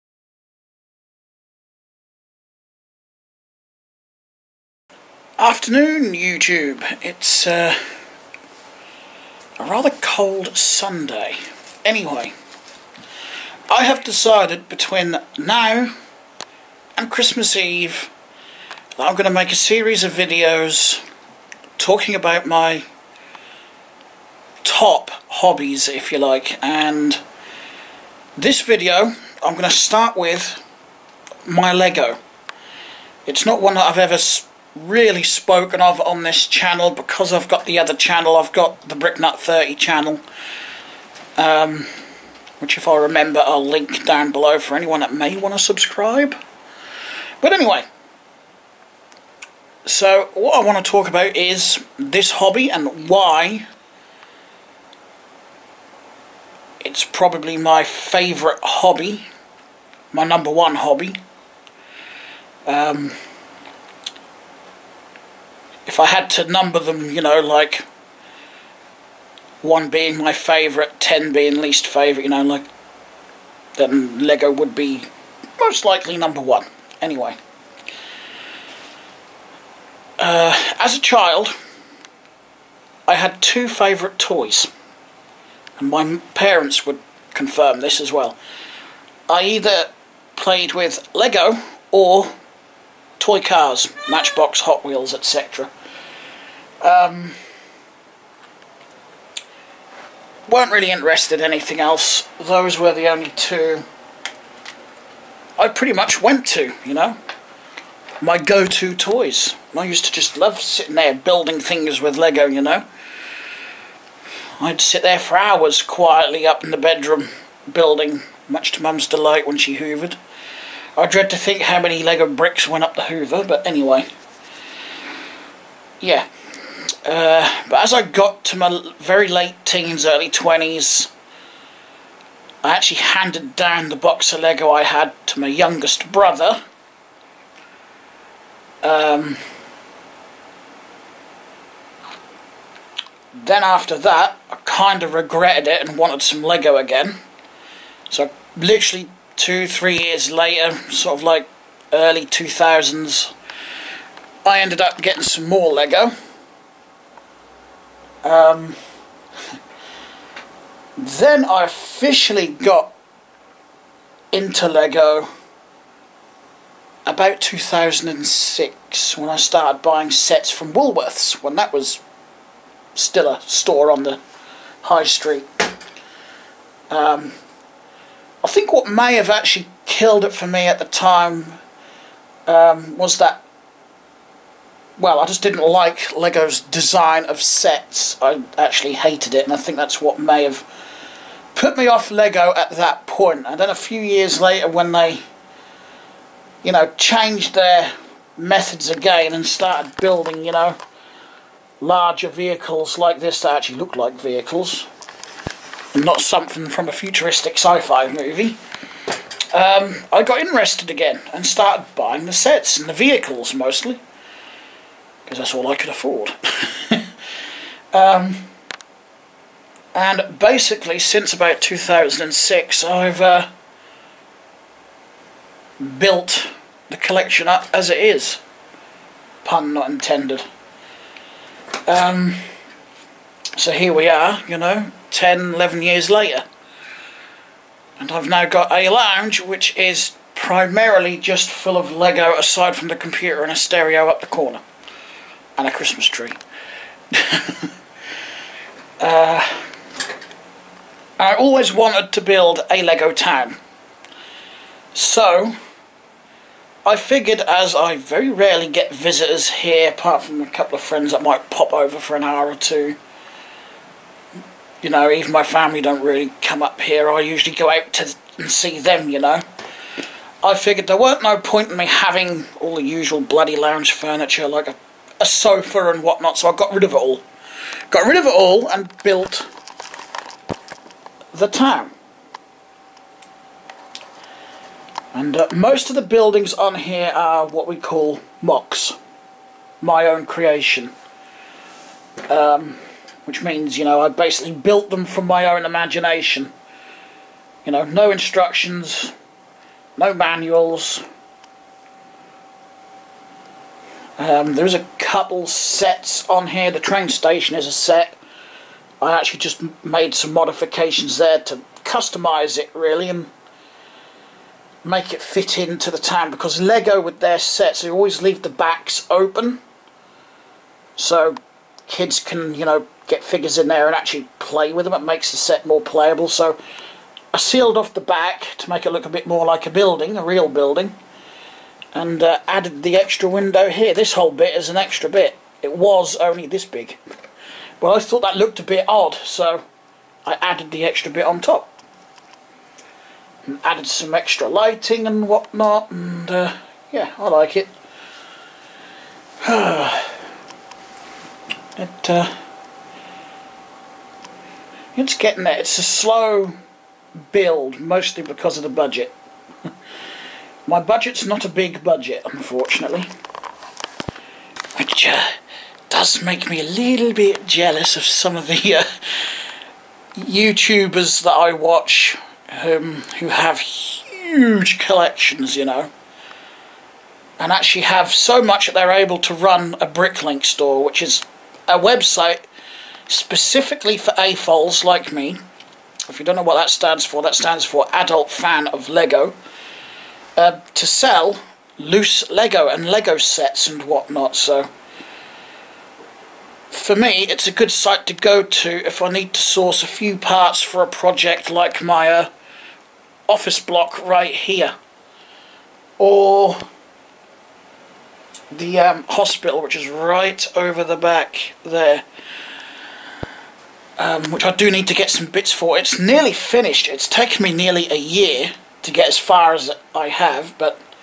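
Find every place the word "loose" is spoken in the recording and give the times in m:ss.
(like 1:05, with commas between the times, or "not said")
6:31.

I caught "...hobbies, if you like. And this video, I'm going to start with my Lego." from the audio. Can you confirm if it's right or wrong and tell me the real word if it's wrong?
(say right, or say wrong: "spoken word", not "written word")
right.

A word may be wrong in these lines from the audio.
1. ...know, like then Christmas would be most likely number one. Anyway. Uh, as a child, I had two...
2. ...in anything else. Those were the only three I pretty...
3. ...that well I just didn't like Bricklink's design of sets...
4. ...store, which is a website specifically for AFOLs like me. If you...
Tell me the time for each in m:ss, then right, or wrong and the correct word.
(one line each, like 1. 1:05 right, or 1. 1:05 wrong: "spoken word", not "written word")
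1. 1:12 wrong: "Lego", not "Christmas"
2. 1:41 wrong: "two", not "three"
3. 3:03 wrong: "Lego", not "Bricklink"
4. 6:20 right.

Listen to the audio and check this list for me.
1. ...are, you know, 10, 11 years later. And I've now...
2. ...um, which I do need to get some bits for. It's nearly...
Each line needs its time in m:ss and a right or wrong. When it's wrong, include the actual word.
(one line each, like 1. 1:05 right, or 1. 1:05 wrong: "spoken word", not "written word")
1. 3:54 right
2. 6:54 right.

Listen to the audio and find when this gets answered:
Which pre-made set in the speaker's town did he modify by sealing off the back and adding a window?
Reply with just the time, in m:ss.
5:06.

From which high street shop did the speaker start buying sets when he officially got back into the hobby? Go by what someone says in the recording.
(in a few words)
Woolworths.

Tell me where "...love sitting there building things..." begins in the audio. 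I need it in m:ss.
1:50.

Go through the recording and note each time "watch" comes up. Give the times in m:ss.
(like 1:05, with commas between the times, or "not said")
6:11.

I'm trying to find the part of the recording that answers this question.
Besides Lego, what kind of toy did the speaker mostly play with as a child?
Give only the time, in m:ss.
1:33.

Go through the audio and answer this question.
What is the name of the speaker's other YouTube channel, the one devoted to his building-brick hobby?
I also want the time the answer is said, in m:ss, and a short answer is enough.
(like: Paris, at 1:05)
Bricknut 30, at 0:38.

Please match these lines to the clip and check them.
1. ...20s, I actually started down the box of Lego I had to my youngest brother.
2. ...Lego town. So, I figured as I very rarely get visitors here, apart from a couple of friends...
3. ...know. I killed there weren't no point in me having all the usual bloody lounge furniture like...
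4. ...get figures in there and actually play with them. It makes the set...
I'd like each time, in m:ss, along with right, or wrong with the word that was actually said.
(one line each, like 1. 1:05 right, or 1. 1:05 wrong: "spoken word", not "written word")
1. 2:10 wrong: "handed", not "started"
2. 4:12 right
3. 4:29 wrong: "figured", not "killed"
4. 5:23 right.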